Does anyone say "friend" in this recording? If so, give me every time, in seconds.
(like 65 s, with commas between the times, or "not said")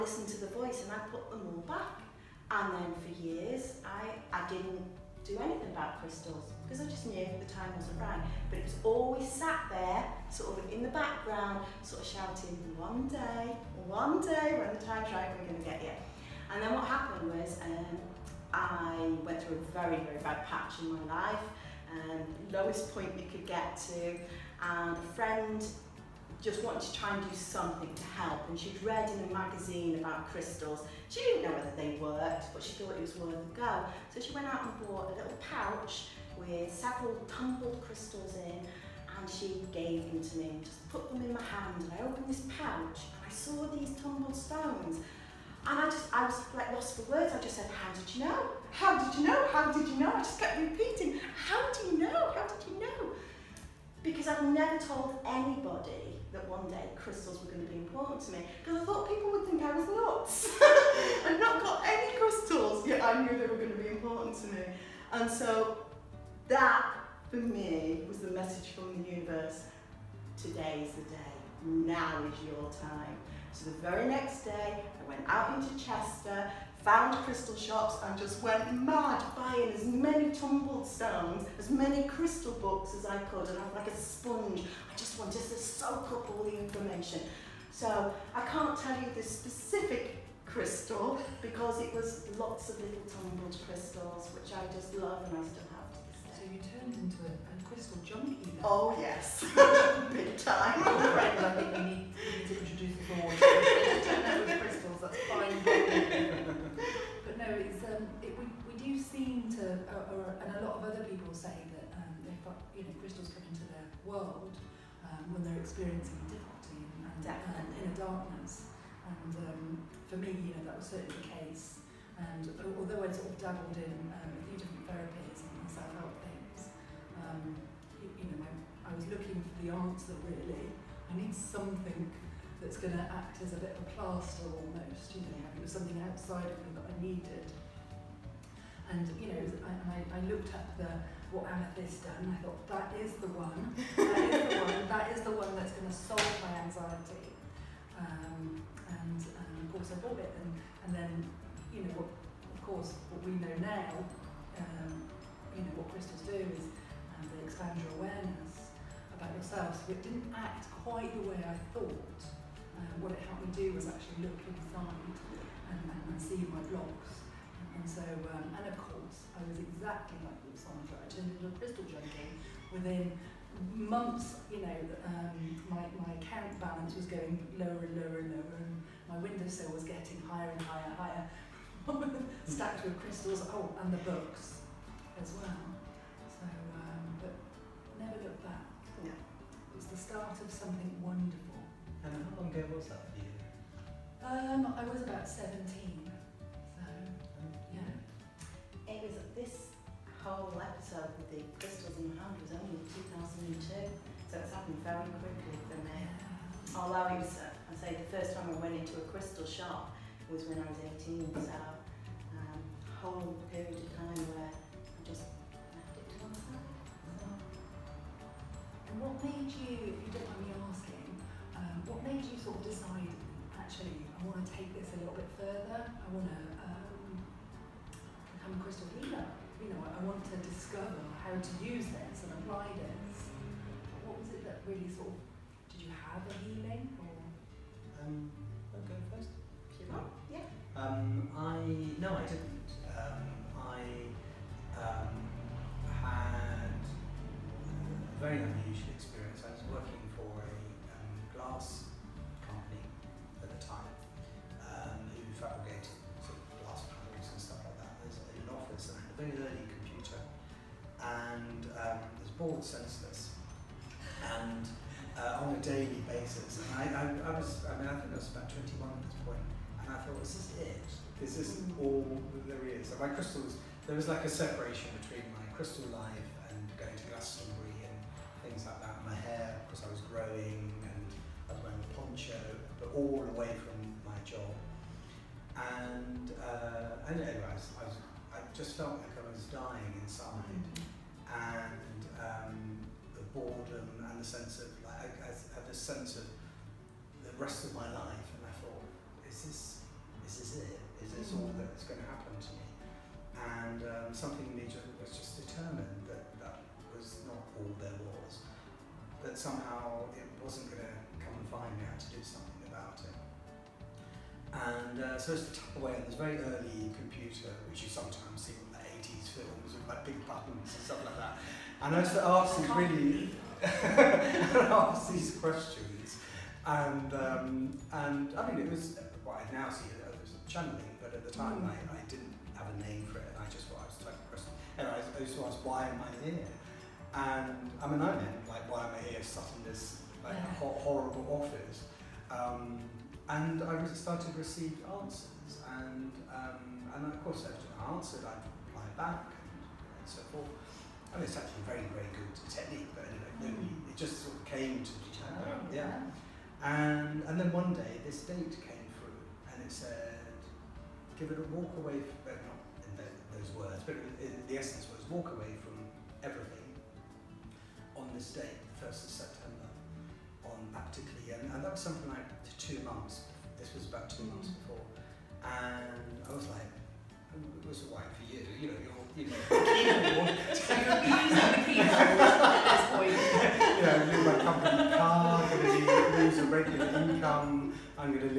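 25 s, 100 s.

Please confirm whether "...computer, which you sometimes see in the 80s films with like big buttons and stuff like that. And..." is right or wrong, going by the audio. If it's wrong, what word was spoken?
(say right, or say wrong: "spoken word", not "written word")
right.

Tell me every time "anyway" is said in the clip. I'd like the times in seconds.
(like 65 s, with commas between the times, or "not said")
287 s, 353 s.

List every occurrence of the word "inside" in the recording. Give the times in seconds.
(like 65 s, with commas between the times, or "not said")
164 s, 290 s.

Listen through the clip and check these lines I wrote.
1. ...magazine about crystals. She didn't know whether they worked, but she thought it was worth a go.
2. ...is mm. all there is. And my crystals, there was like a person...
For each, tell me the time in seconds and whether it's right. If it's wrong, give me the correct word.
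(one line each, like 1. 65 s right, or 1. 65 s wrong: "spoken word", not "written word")
1. 29 s right
2. 271 s wrong: "separation", not "person".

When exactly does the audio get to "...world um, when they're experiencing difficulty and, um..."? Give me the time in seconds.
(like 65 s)
114 s.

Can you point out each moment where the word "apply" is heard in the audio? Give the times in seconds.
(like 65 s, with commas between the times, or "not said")
232 s.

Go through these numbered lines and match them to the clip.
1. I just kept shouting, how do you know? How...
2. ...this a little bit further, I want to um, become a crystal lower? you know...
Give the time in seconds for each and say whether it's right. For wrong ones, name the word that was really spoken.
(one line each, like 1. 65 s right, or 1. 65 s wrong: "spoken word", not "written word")
1. 50 s wrong: "repeating", not "shouting"
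2. 224 s wrong: "healer", not "lower".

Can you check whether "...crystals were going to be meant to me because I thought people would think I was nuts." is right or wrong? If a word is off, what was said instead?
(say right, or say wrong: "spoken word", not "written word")
wrong: "important", not "meant".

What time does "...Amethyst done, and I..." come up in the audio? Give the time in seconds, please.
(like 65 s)
141 s.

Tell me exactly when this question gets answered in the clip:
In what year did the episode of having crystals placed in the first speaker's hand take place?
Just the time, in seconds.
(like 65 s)
203 s.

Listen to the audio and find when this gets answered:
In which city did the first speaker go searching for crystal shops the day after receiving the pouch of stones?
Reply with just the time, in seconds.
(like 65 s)
75 s.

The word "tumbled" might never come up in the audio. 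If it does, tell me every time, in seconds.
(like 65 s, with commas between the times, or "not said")
37 s, 44 s, 80 s, 93 s.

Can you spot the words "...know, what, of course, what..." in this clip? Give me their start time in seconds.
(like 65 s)
151 s.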